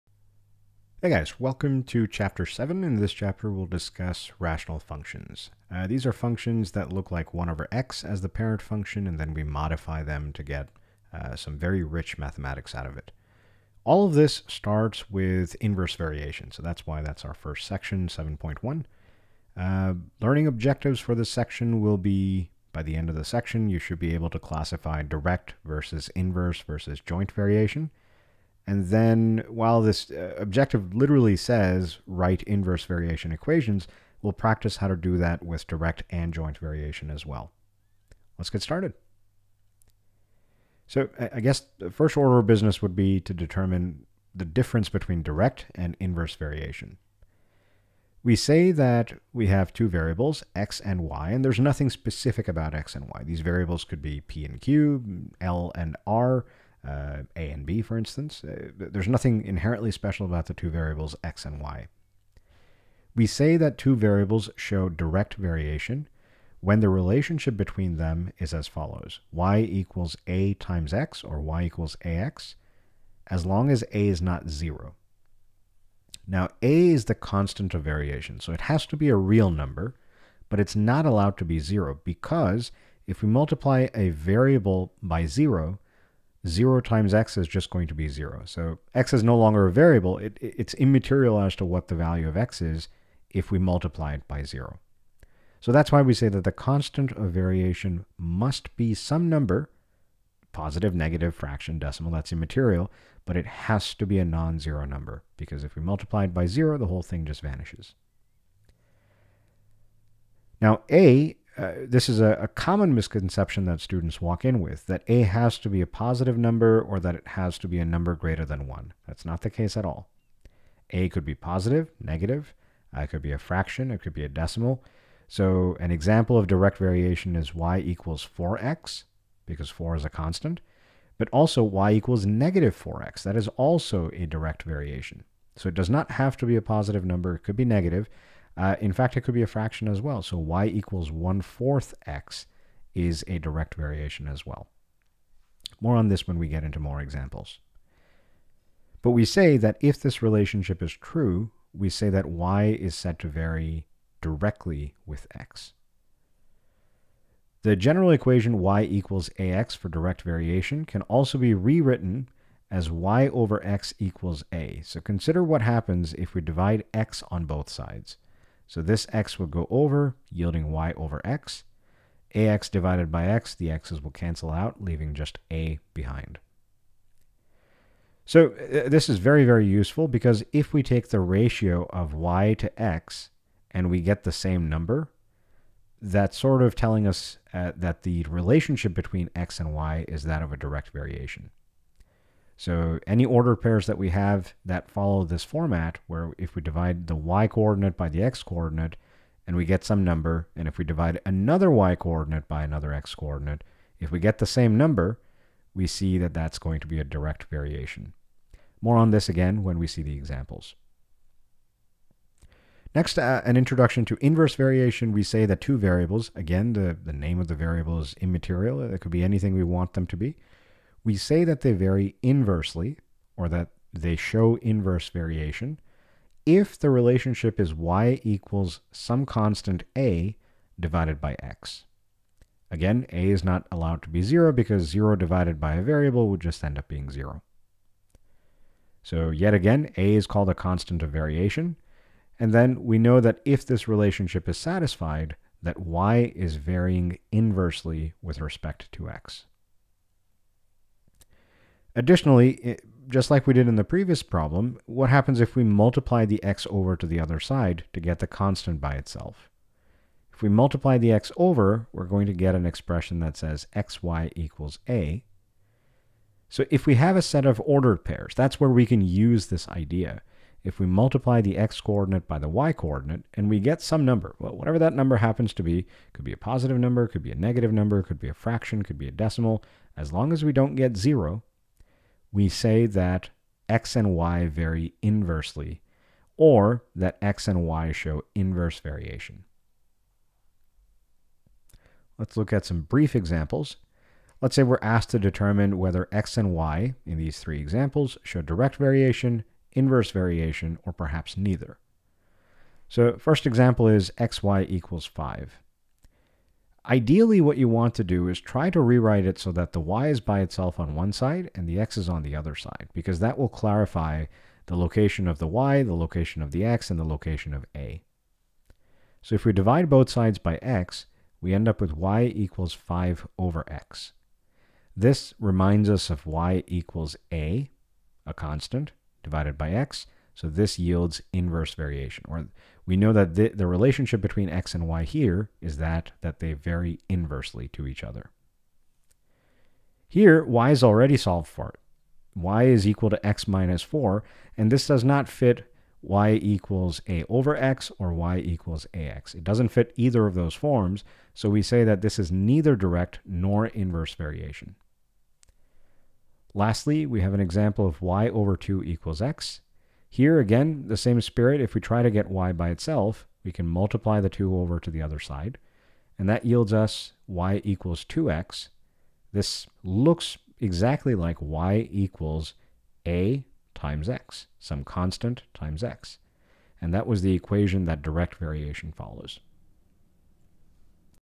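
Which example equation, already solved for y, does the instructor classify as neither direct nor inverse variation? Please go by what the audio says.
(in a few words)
y = x - 4.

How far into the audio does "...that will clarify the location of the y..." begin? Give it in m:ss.
5:13.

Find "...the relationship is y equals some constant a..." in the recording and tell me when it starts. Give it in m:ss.
3:46.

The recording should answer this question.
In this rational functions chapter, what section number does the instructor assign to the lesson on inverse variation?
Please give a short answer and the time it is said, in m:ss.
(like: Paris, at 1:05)
7.1, at 0:18.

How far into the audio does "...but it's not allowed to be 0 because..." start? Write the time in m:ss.
1:20.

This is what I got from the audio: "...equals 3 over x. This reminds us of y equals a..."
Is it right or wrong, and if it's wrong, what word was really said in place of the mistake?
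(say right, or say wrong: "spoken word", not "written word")
wrong: "5", not "3".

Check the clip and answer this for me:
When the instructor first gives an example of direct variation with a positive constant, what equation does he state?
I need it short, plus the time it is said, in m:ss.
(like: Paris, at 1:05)
y = 4x, at 2:07.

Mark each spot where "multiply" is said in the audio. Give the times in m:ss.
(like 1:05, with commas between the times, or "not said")
1:23, 1:33, 1:45, 4:15, 4:20, 4:30, 6:03.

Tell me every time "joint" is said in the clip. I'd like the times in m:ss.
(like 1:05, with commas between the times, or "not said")
0:27, 0:36.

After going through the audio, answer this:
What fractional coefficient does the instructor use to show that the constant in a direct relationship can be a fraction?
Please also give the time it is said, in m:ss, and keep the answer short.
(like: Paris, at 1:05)
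1/4, at 2:21.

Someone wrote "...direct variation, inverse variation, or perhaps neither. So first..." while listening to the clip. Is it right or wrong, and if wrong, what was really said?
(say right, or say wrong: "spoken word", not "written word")
right.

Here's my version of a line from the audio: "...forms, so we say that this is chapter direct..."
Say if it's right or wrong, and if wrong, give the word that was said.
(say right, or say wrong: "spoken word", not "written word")
wrong: "neither", not "chapter".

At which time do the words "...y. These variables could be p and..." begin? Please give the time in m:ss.
0:53.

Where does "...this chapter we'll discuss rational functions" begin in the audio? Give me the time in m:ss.
0:02.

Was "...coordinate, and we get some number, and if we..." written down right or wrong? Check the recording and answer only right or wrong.
right.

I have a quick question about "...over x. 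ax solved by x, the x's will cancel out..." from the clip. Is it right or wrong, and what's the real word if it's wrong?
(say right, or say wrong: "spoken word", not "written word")
wrong: "divided", not "solved".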